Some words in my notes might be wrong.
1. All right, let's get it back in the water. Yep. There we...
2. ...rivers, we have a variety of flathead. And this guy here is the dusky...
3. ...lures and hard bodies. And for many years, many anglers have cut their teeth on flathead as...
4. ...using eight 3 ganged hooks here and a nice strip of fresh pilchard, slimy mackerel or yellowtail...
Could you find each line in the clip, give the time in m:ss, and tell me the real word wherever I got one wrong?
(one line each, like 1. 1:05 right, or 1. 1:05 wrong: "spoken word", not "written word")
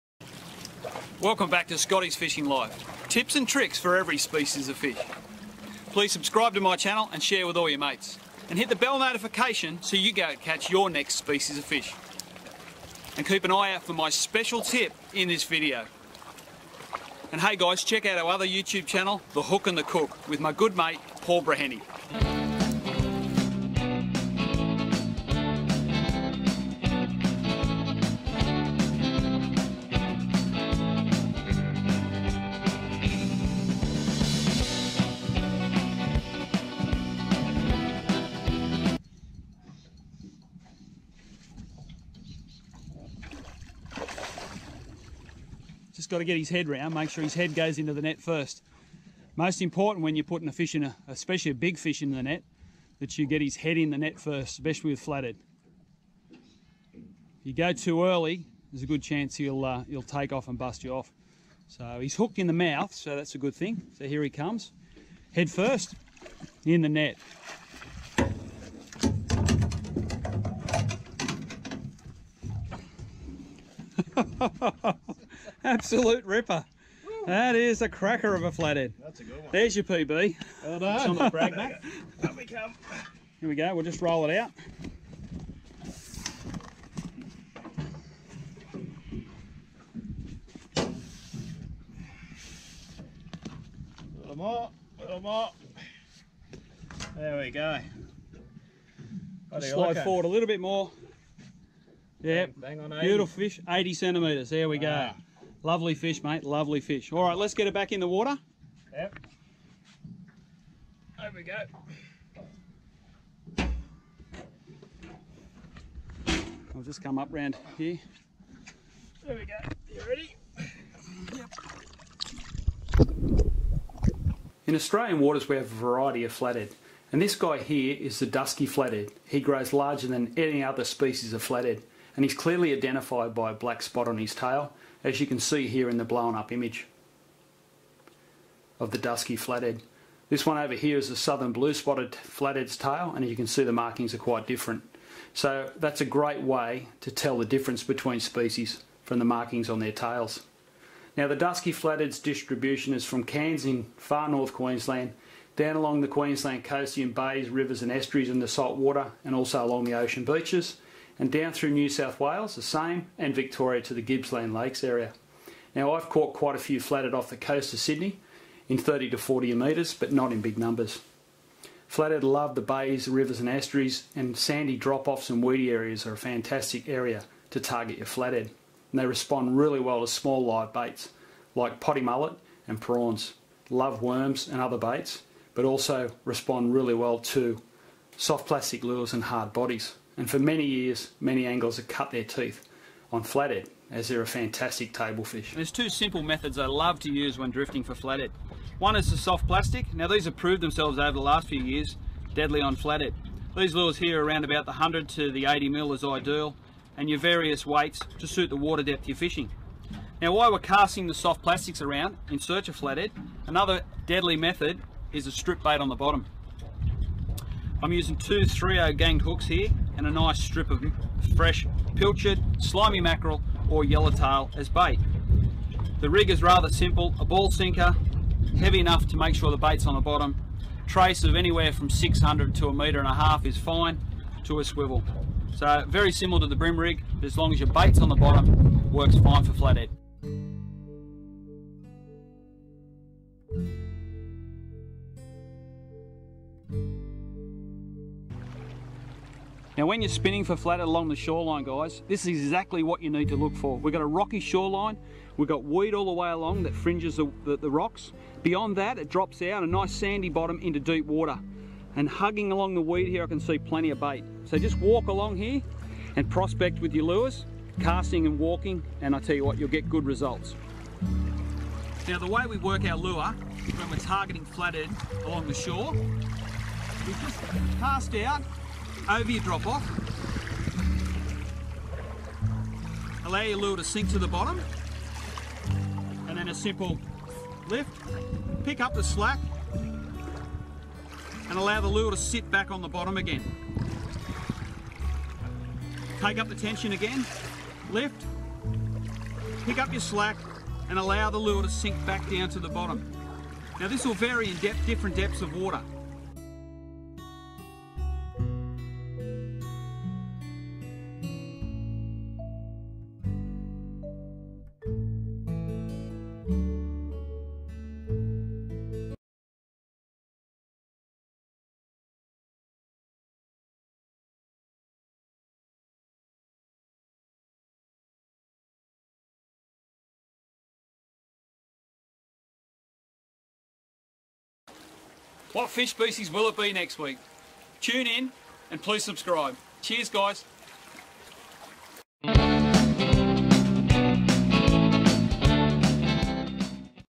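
1. 1:47 right
2. 2:05 wrong: "waters", not "rivers"
3. 3:08 right
4. 3:37 wrong: "two", not "eight".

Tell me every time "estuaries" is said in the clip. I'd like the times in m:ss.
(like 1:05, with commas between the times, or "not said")
2:37, 2:53.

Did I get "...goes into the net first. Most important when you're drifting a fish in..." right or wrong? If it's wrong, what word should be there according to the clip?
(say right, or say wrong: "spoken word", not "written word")
wrong: "putting", not "drifting".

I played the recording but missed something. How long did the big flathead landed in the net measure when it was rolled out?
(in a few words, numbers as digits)
80 centimetres.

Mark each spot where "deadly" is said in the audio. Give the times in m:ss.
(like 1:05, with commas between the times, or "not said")
3:22, 3:34.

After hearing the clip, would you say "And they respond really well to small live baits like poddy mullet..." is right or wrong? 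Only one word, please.
right.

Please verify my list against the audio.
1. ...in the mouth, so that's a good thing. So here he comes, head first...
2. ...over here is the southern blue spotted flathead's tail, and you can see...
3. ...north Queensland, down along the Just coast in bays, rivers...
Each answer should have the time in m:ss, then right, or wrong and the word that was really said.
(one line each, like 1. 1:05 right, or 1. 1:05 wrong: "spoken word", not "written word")
1. 1:02 right
2. 2:20 right
3. 2:34 wrong: "Queensland", not "Just".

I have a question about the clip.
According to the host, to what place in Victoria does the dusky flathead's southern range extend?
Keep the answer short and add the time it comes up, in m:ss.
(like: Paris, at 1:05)
Gippsland Lakes, at 2:44.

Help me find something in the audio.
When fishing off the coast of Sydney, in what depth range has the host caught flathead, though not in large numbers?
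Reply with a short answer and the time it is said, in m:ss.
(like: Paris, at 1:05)
30 to 40 metres, at 2:48.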